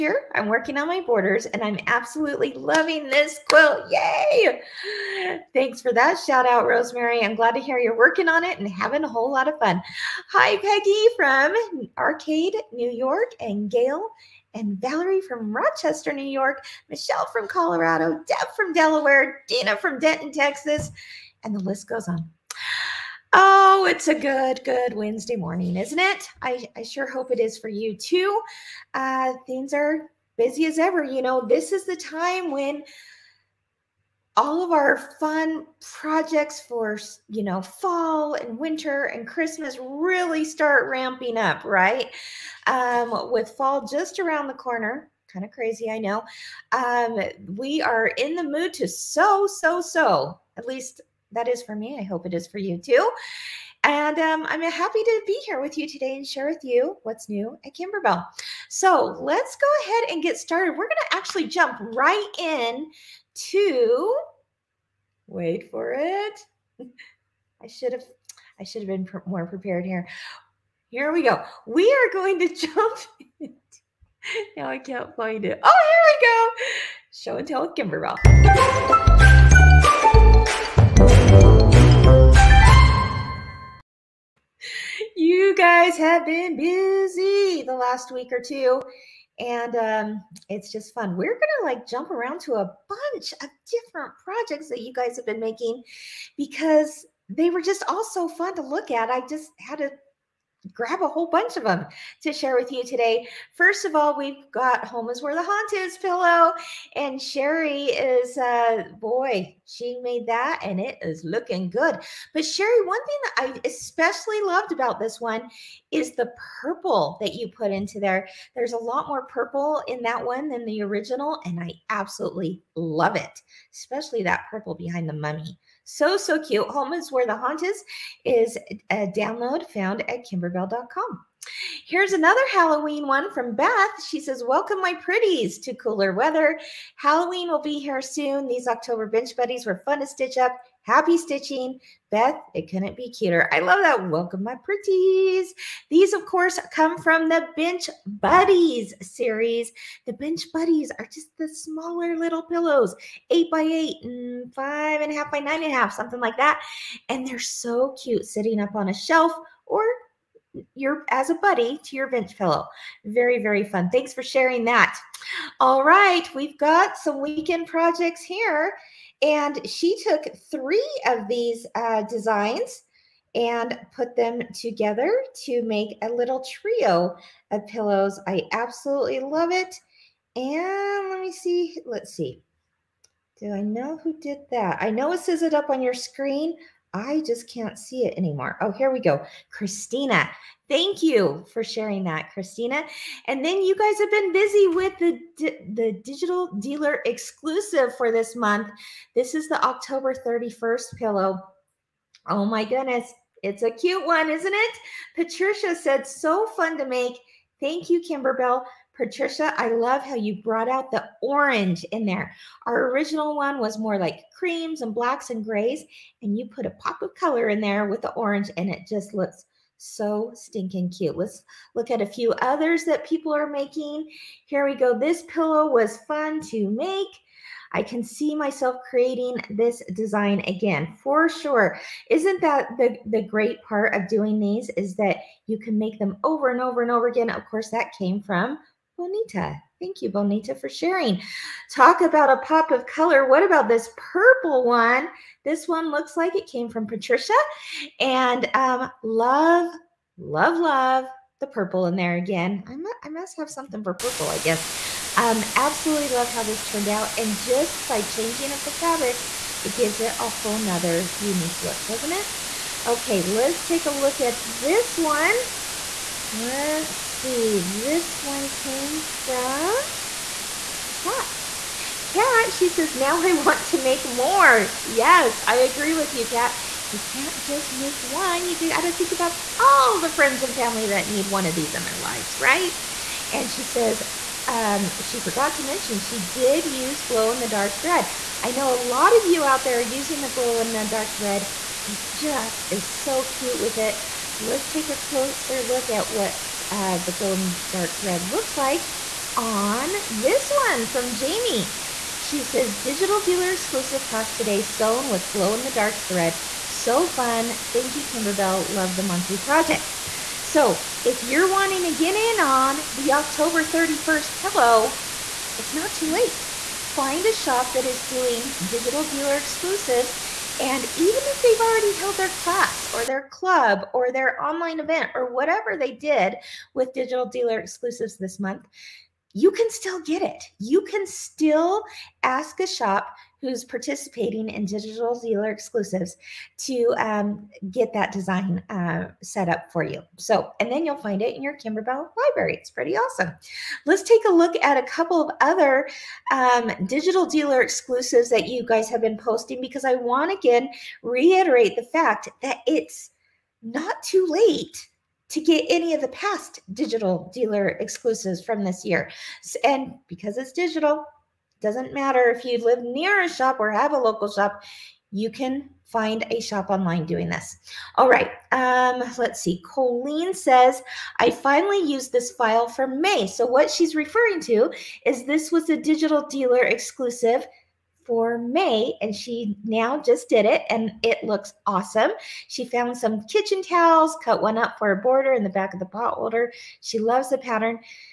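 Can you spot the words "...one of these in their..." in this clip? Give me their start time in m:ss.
4:41.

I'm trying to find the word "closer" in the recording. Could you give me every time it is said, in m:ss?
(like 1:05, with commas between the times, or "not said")
4:54.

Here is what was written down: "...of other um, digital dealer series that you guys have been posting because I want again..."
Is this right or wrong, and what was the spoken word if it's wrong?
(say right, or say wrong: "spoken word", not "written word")
wrong: "exclusives", not "series".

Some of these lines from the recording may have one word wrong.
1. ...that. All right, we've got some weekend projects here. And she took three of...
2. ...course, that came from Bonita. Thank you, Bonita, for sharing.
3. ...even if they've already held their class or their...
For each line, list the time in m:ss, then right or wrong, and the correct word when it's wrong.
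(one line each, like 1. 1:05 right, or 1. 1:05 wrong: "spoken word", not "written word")
1. 2:44 right
2. 3:57 right
3. 5:20 right.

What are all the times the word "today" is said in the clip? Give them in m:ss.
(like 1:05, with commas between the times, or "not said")
0:55, 1:42, 5:04.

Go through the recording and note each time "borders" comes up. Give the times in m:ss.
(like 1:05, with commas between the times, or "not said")
0:00, 6:24.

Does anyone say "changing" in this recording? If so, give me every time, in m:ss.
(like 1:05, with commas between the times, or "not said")
4:18.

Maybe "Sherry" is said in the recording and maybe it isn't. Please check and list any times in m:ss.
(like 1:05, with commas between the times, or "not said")
1:47, 1:52.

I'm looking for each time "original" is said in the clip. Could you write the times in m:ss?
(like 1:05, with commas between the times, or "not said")
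2:00, 3:32.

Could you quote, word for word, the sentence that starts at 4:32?
Kat, she says, now I want to make more.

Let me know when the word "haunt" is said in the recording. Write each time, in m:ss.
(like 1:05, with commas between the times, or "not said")
1:45, 2:07.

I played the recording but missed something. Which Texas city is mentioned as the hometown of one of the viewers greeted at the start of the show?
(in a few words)
Denton.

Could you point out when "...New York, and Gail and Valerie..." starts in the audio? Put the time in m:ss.
0:12.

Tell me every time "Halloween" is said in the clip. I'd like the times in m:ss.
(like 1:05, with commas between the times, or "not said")
2:12, 2:16.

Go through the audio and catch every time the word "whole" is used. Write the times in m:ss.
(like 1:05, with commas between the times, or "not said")
0:09, 1:41, 4:20.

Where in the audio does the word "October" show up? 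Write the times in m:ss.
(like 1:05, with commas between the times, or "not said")
2:18, 3:19, 5:13.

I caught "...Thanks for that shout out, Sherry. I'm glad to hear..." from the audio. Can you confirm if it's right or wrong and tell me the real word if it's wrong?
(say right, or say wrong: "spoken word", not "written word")
wrong: "Rosemary", not "Sherry".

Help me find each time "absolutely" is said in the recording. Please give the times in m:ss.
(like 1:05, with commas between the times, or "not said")
0:01, 2:01, 2:58, 4:15.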